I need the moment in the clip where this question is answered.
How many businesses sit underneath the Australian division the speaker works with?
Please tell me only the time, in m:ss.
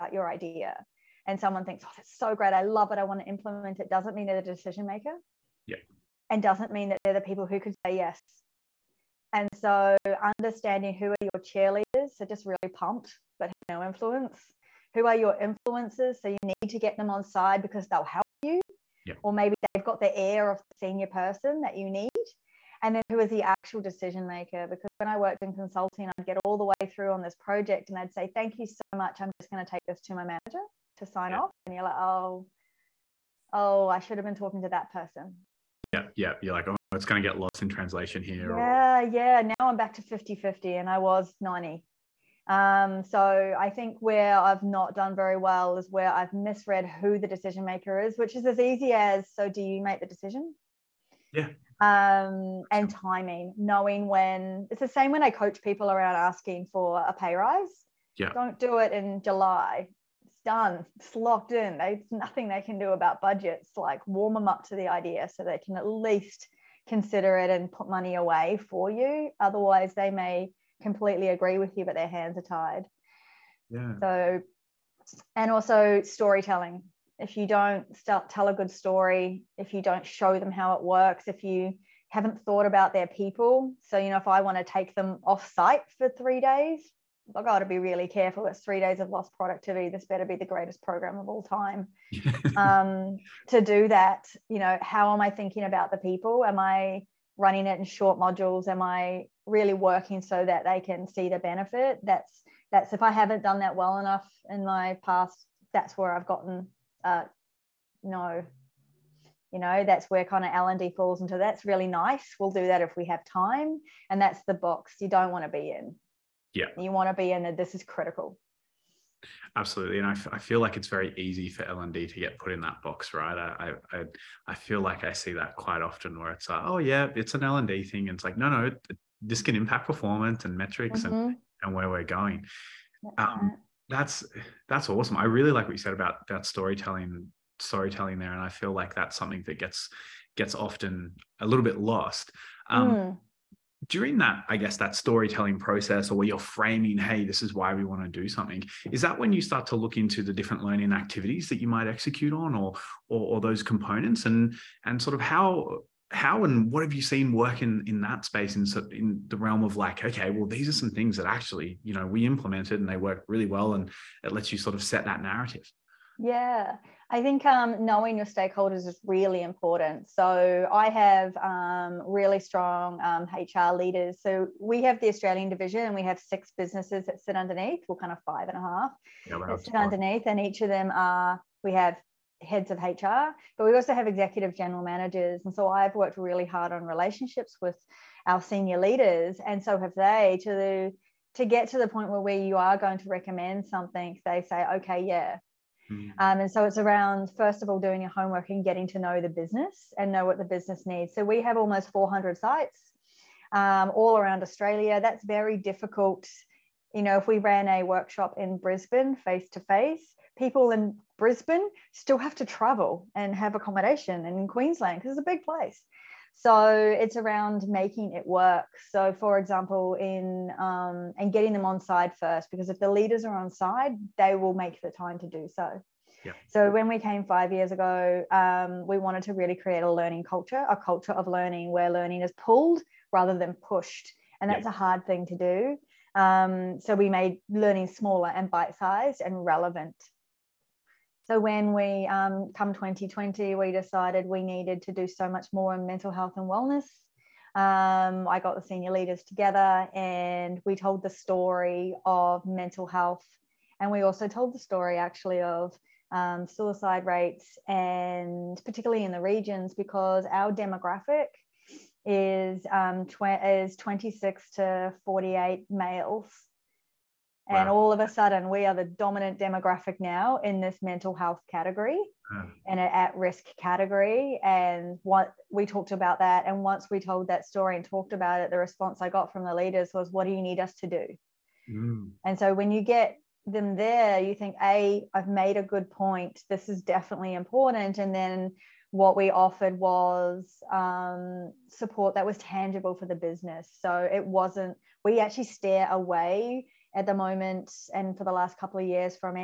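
2:56.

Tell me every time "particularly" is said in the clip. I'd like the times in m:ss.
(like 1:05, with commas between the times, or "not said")
4:18.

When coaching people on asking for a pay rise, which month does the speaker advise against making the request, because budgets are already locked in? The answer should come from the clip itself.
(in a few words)
July.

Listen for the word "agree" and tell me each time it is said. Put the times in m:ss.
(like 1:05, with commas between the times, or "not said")
1:11.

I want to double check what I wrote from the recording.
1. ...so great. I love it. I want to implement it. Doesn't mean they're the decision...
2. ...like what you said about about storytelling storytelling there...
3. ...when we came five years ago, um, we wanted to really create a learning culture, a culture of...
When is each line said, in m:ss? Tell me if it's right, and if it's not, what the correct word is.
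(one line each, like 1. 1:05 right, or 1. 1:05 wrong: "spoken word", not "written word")
1. 0:02 right
2. 2:15 right
3. 3:46 right.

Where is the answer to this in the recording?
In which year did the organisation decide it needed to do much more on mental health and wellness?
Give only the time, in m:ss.
4:02.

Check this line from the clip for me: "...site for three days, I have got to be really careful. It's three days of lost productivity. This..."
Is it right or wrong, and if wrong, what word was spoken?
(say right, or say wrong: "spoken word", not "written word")
right.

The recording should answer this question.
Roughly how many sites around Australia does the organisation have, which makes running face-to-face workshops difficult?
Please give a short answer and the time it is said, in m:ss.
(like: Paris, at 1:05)
400, at 3:21.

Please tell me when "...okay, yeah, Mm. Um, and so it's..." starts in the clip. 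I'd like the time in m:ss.
3:14.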